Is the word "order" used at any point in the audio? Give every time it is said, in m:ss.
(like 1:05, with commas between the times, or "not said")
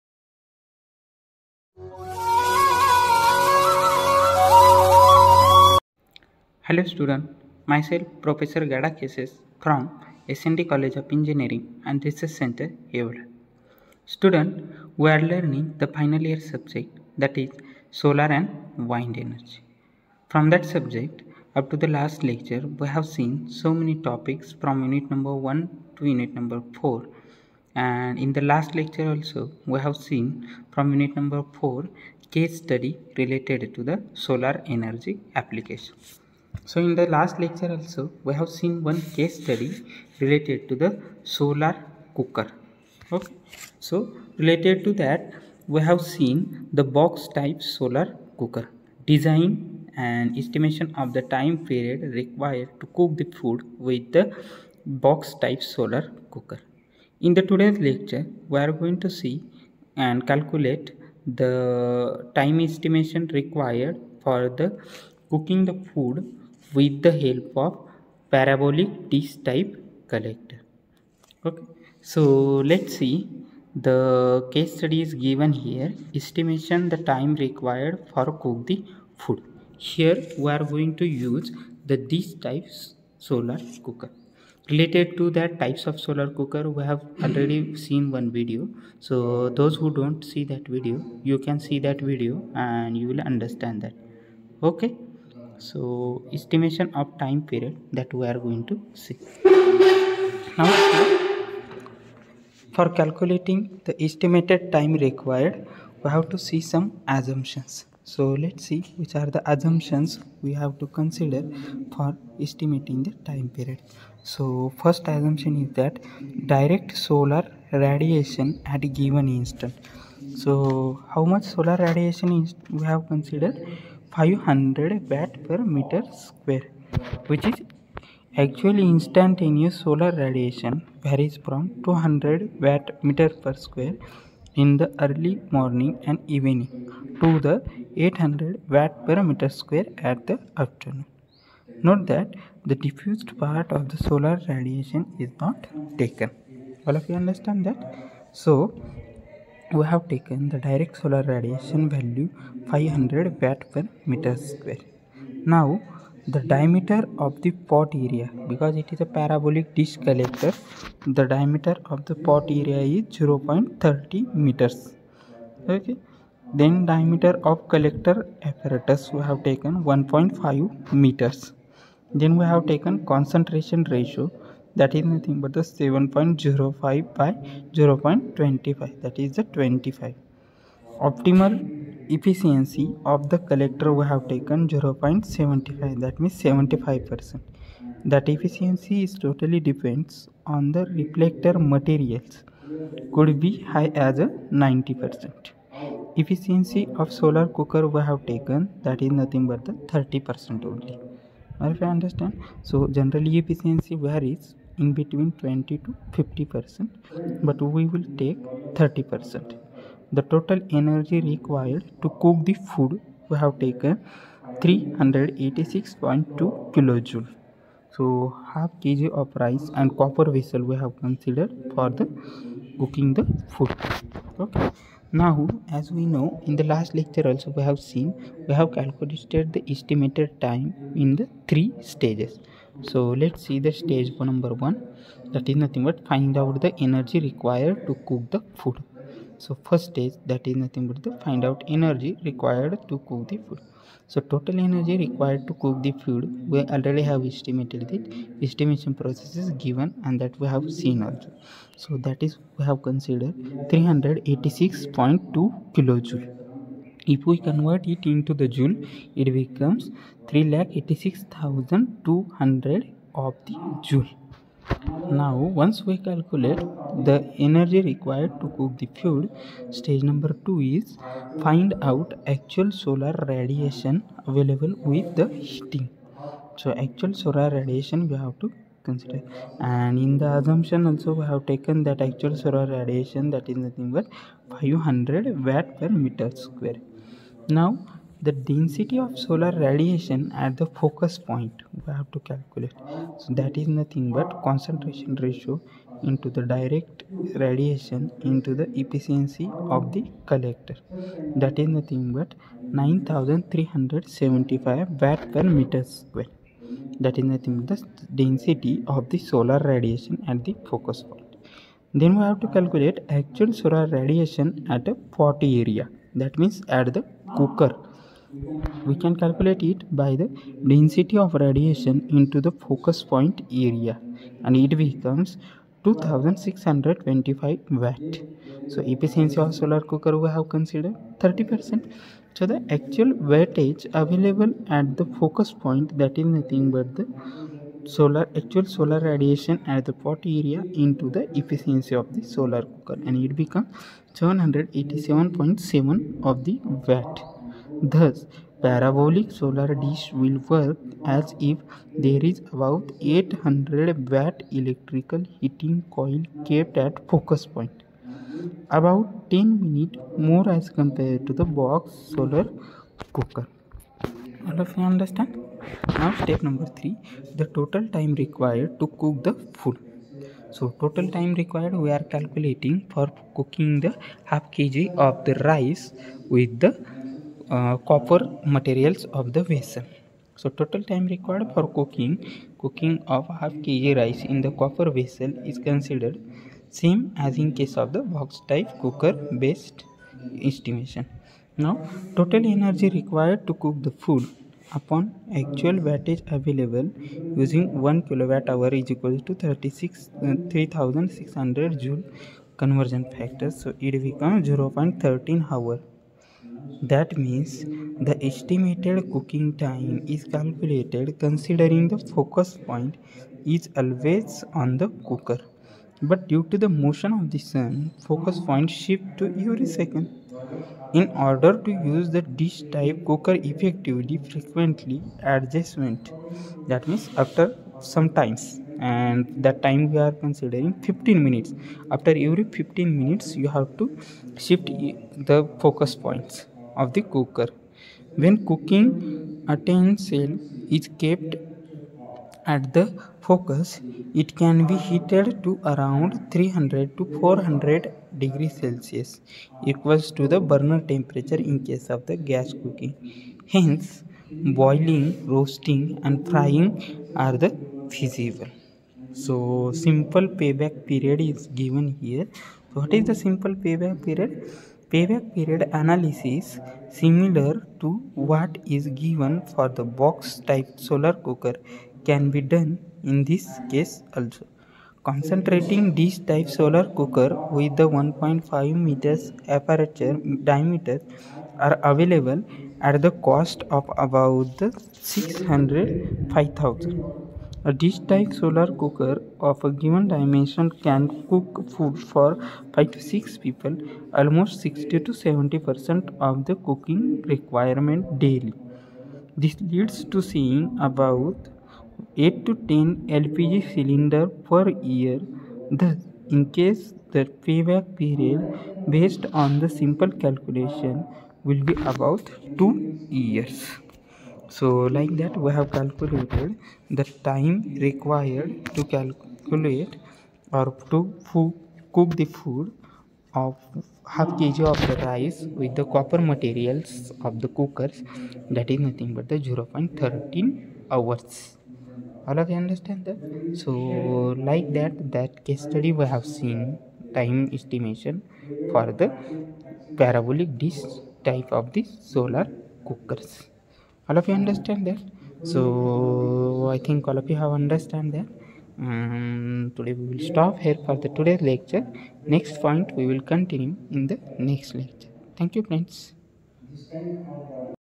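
7:01.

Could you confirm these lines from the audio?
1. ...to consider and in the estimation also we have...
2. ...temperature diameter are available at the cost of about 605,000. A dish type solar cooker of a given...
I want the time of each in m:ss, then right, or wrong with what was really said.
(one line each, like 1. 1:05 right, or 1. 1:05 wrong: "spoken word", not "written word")
1. 4:38 wrong: "assumption", not "estimation"
2. 7:59 wrong: "aperture", not "temperature".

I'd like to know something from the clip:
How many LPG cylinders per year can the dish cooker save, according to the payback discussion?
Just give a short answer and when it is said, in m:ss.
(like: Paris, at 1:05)
8 to 10, at 8:22.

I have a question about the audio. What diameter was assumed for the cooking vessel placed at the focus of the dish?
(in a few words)
0.30 m.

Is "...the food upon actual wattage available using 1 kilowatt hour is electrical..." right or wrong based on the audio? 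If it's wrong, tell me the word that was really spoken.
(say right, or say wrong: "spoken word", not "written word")
wrong: "equal", not "electrical".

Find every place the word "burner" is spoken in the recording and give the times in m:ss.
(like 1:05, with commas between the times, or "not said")
7:30.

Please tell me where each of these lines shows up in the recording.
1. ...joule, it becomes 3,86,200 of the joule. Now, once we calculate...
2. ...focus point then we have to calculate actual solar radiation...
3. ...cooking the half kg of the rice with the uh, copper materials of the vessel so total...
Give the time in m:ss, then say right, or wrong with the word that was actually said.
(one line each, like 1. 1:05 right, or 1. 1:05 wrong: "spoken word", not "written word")
1. 4:18 right
2. 5:10 right
3. 6:13 right.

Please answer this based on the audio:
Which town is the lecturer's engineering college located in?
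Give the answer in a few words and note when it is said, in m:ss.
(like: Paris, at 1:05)
Yeola, at 0:12.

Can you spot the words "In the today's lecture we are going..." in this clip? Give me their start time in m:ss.
0:57.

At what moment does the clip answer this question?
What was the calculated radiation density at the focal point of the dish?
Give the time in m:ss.
5:02.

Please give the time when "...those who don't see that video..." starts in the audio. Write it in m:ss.
1:29.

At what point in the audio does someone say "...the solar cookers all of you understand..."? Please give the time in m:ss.
9:01.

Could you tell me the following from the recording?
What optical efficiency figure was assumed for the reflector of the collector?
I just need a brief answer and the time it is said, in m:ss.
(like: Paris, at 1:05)
0.75, at 3:04.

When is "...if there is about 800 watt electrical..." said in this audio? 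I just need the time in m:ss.
5:51.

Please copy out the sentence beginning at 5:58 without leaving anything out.
About 10 minutes more as compared to the box solar cooker.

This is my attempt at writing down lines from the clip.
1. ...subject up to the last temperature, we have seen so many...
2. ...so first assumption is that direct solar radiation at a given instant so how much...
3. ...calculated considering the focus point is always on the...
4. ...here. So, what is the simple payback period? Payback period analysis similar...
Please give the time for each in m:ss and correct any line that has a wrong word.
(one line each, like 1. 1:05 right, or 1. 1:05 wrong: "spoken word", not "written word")
1. 0:20 wrong: "lecture", not "temperature"
2. 1:54 right
3. 6:50 right
4. 7:41 right.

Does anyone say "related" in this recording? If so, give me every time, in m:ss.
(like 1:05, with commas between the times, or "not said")
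0:33, 0:40, 0:44, 1:24.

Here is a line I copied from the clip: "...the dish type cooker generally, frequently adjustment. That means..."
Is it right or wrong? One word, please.
wrong.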